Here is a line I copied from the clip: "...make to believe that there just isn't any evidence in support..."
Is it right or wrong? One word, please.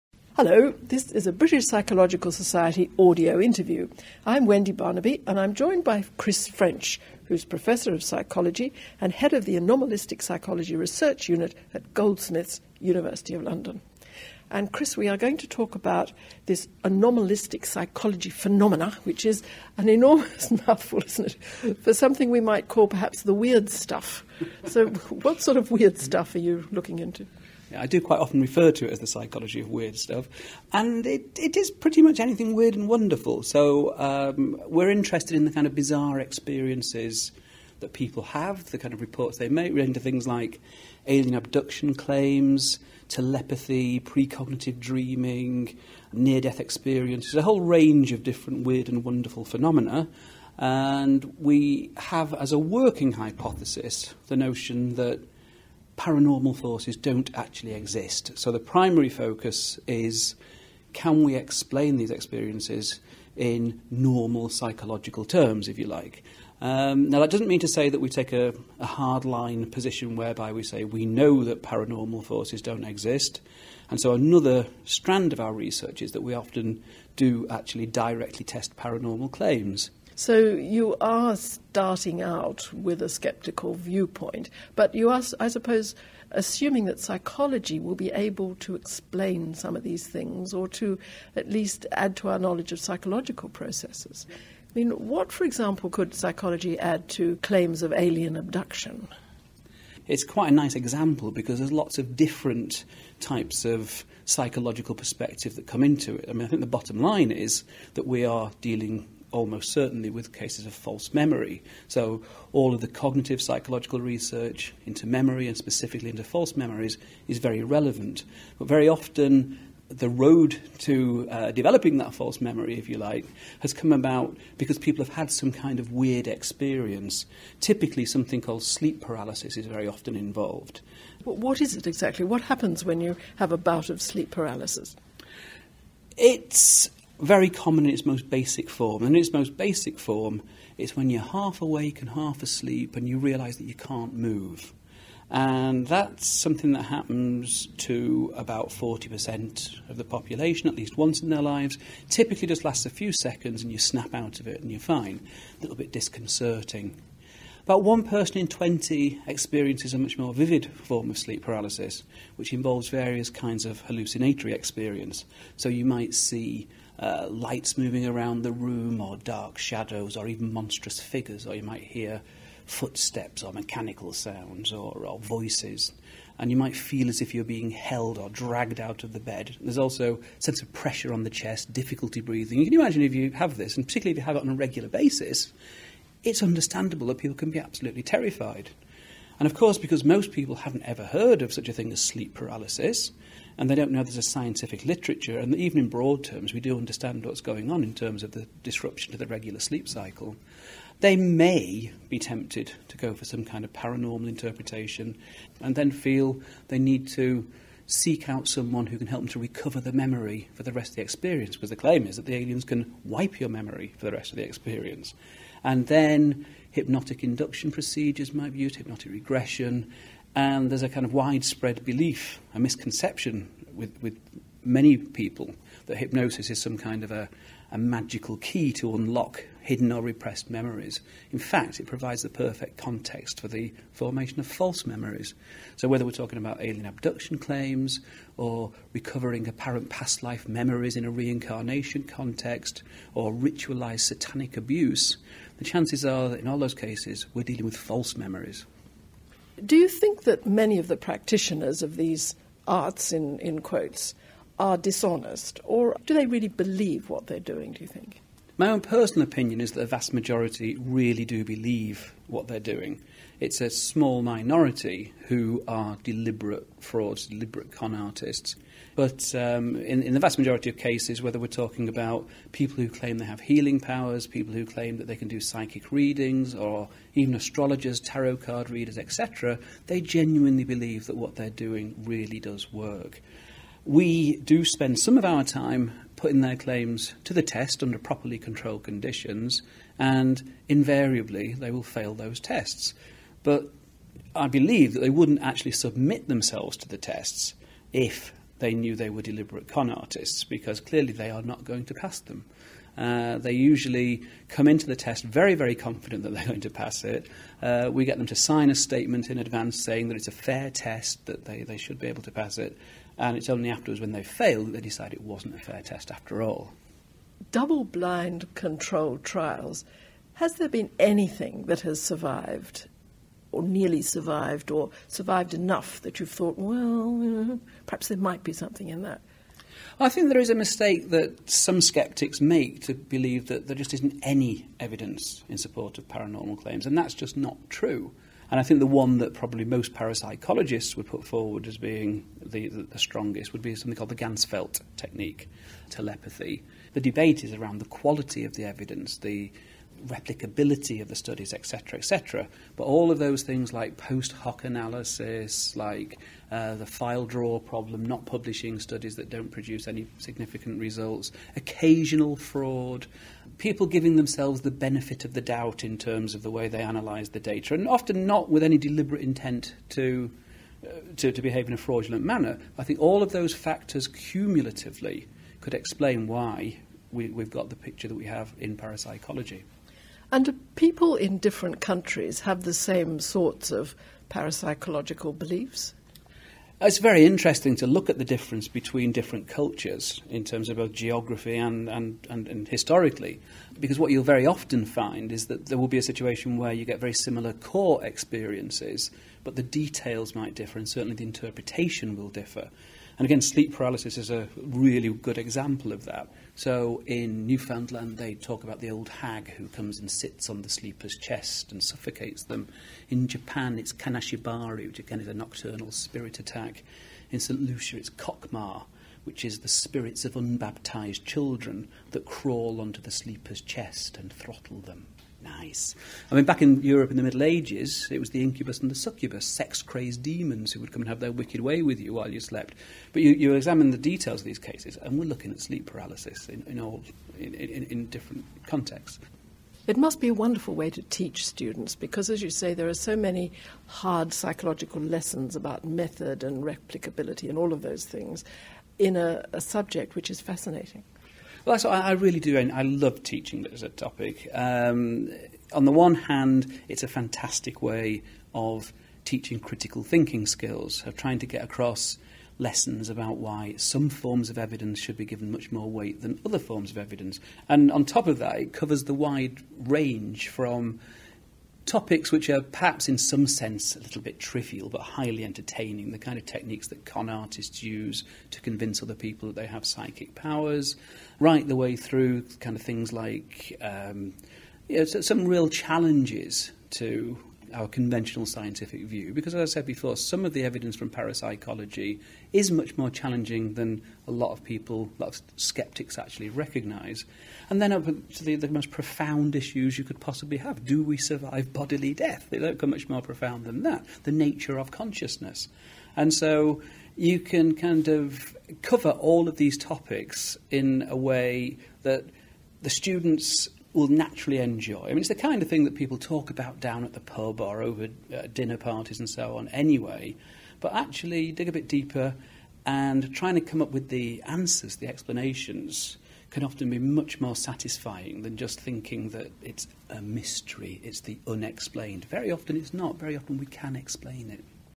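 right.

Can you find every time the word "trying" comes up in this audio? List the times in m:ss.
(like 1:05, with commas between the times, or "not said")
7:41, 8:43.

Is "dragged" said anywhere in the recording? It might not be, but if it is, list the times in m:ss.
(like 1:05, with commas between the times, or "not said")
2:58.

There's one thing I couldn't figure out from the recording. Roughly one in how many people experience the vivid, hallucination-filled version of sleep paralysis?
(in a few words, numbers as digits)
20.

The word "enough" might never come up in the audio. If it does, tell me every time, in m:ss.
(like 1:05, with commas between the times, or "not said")
5:25.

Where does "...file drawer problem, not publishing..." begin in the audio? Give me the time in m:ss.
5:56.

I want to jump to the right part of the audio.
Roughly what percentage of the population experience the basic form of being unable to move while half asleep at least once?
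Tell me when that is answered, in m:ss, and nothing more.
2:28.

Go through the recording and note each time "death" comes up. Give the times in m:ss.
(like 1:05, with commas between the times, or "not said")
0:46, 8:22.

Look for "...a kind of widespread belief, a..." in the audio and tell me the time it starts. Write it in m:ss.
3:40.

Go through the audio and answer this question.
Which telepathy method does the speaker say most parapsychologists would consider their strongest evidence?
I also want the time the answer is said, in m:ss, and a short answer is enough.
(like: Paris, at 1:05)
Ganzfeld technique, at 5:44.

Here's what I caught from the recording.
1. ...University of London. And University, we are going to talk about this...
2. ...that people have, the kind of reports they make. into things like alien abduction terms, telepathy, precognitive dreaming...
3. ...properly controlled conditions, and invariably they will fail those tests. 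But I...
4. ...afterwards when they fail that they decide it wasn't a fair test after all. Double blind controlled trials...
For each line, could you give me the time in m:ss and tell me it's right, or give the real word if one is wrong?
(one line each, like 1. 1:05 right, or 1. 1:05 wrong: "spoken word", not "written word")
1. 0:12 wrong: "Chris", not "University"
2. 0:37 wrong: "claims", not "terms"
3. 4:47 right
4. 5:13 right.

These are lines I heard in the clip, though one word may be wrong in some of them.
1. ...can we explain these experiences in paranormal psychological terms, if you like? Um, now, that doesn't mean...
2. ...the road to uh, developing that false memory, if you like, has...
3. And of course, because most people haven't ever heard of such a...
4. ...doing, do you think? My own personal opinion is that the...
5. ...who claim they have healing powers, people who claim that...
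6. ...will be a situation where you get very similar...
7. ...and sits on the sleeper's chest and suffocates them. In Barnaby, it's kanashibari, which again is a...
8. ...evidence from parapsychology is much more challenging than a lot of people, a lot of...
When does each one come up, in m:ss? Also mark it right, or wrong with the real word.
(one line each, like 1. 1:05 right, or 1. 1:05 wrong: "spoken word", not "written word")
1. 1:00 wrong: "normal", not "paranormal"
2. 1:59 right
3. 3:09 right
4. 4:17 right
5. 4:32 right
6. 6:35 right
7. 6:49 wrong: "Japan", not "Barnaby"
8. 8:10 right.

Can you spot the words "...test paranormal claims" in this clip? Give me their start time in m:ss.
1:18.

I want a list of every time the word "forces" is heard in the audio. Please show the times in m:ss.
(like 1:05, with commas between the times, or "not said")
0:56, 1:12.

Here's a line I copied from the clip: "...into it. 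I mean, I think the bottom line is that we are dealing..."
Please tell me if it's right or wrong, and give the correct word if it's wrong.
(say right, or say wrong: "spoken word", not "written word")
right.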